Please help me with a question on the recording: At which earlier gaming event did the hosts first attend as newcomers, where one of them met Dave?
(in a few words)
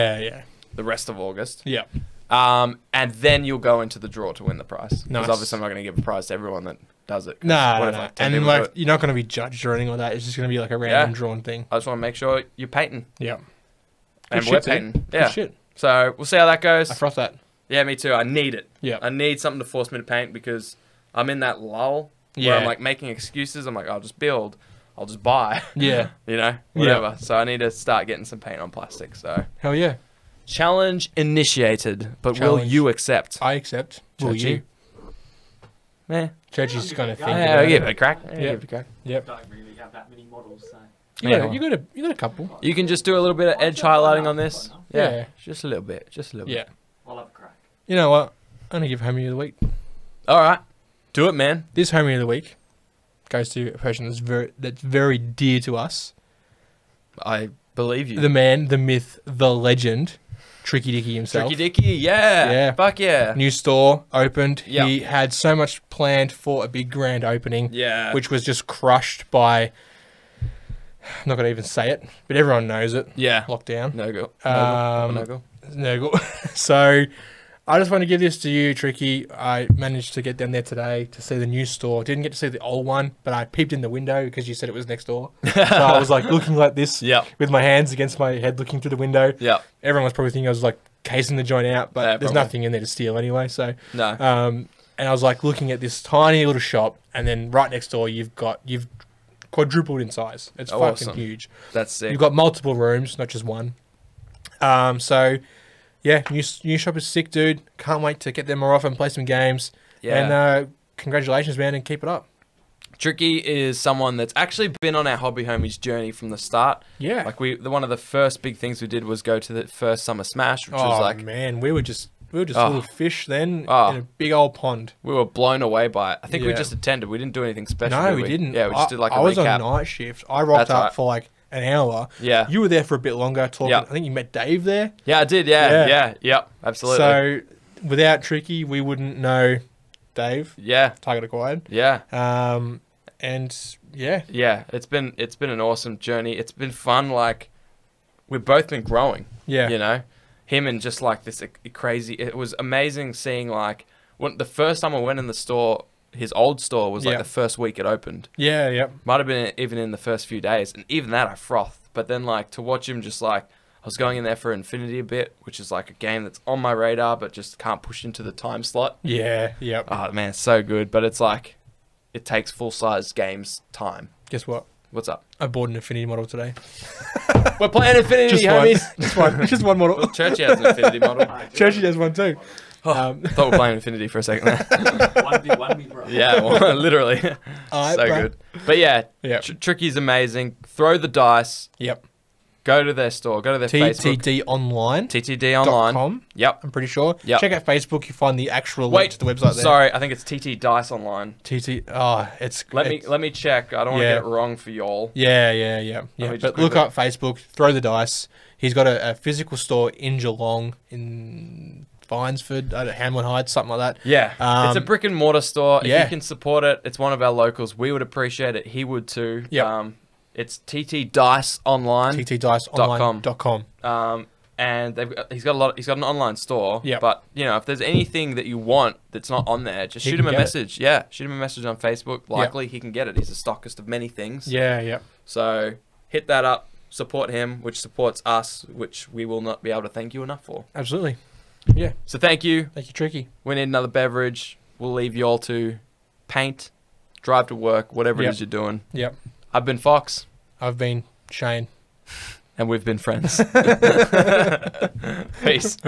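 Summer Smash.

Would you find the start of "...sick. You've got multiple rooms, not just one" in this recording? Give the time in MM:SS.
01:41.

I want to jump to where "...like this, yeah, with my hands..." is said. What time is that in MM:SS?
01:26.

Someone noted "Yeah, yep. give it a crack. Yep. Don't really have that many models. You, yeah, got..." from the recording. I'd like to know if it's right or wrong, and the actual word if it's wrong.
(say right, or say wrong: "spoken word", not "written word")
right.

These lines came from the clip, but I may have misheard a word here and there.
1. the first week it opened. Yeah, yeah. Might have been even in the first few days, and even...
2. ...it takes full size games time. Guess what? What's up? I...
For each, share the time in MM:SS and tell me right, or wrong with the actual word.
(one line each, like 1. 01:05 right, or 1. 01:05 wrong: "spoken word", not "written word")
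1. 02:37 right
2. 02:52 right.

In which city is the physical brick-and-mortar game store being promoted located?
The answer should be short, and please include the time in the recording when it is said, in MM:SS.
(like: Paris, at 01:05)
Geelong, at 03:30.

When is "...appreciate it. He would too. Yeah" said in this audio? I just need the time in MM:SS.
03:38.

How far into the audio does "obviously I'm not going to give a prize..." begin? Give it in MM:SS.
00:05.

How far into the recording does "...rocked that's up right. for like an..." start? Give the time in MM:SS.
02:10.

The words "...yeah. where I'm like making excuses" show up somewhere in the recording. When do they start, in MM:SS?
00:22.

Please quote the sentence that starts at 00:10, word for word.
It's just going to be like a random yeah.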